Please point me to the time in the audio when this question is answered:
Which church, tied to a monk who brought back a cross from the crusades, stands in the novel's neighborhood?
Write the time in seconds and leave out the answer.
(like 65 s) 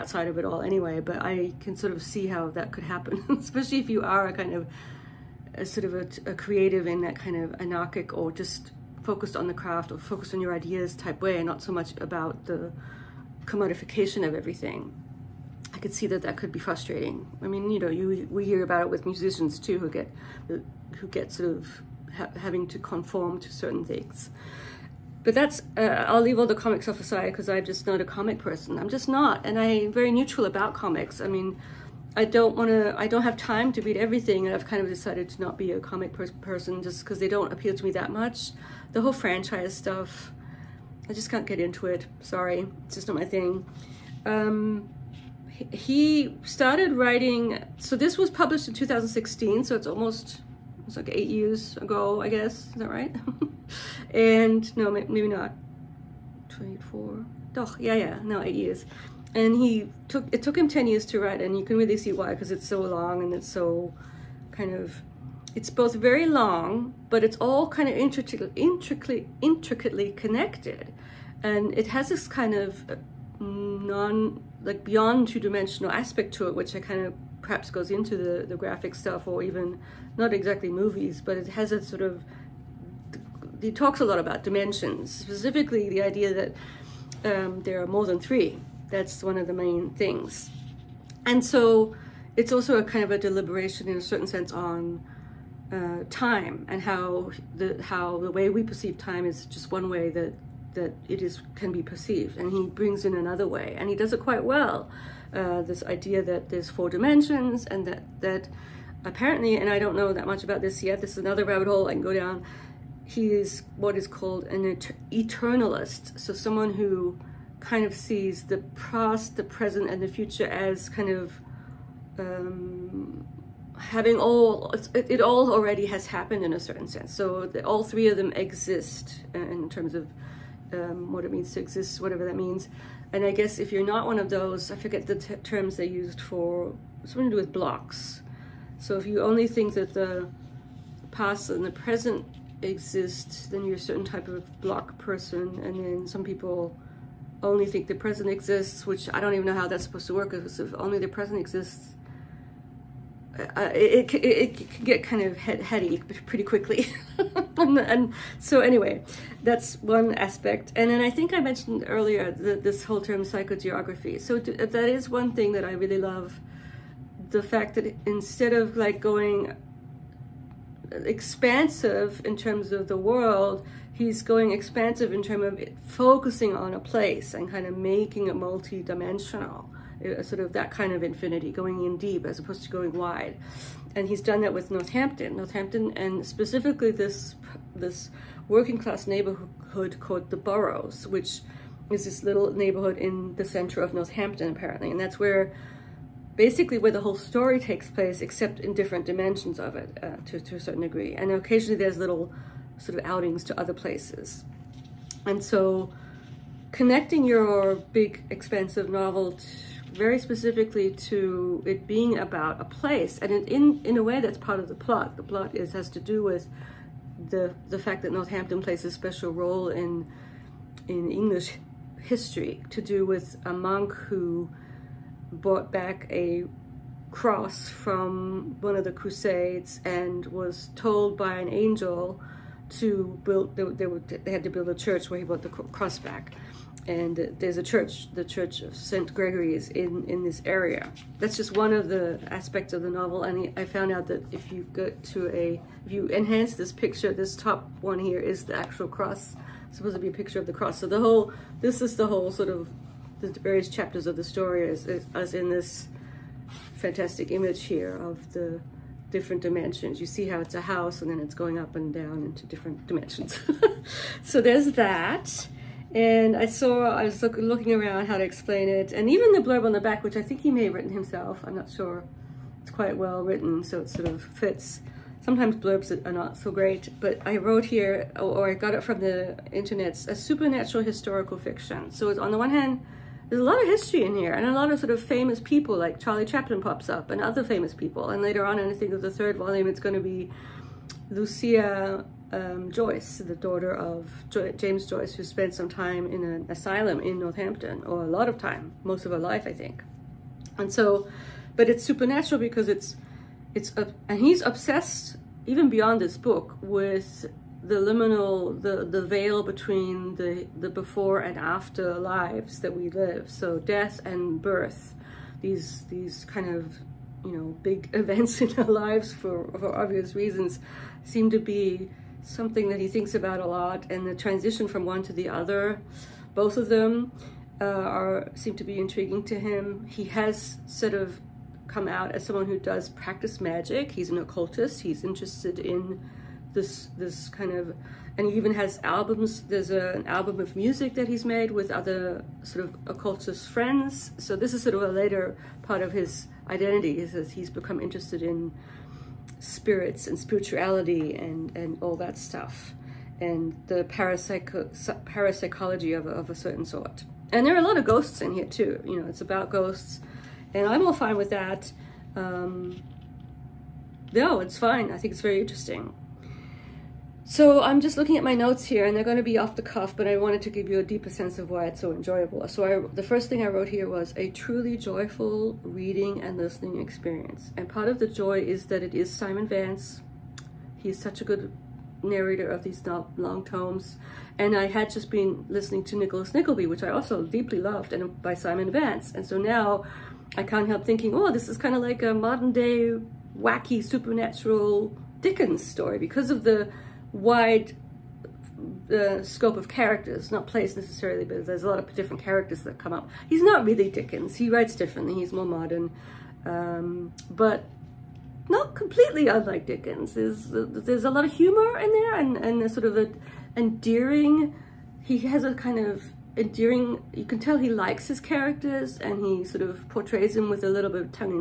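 238 s.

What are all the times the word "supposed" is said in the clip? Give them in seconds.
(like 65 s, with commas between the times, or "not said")
149 s, 249 s.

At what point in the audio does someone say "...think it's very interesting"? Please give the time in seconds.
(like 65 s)
364 s.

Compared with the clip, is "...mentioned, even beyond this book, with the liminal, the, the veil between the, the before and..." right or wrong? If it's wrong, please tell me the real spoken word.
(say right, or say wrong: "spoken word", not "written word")
wrong: "obsessed", not "mentioned".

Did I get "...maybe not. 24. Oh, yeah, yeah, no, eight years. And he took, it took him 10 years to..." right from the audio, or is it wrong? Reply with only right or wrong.
right.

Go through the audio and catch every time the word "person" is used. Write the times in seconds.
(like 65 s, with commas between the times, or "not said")
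28 s, 36 s, 144 s.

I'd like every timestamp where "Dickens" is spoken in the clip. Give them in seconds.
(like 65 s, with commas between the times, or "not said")
395 s, 403 s, 409 s.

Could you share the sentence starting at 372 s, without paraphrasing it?
So I, the first thing I wrote here was a truly joyful reading and listening experience.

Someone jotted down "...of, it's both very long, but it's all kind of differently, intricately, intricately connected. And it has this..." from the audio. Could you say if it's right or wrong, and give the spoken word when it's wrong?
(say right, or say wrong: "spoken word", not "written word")
wrong: "intricately", not "differently".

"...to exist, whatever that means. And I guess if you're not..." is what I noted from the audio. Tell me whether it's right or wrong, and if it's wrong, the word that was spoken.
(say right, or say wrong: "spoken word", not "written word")
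right.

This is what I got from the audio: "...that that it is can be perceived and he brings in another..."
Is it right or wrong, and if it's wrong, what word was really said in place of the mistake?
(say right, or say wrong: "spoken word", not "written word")
right.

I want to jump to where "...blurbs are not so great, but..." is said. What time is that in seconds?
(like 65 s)
275 s.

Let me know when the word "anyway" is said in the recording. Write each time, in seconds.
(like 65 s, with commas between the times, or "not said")
0 s, 158 s.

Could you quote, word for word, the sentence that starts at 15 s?
I could see that that could be frustrating.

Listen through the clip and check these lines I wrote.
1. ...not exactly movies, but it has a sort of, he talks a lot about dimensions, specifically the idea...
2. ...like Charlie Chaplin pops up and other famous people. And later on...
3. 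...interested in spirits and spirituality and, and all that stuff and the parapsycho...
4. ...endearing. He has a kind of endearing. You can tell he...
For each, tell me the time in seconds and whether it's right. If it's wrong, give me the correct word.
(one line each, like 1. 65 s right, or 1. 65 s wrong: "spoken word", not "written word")
1. 80 s right
2. 285 s right
3. 347 s right
4. 413 s right.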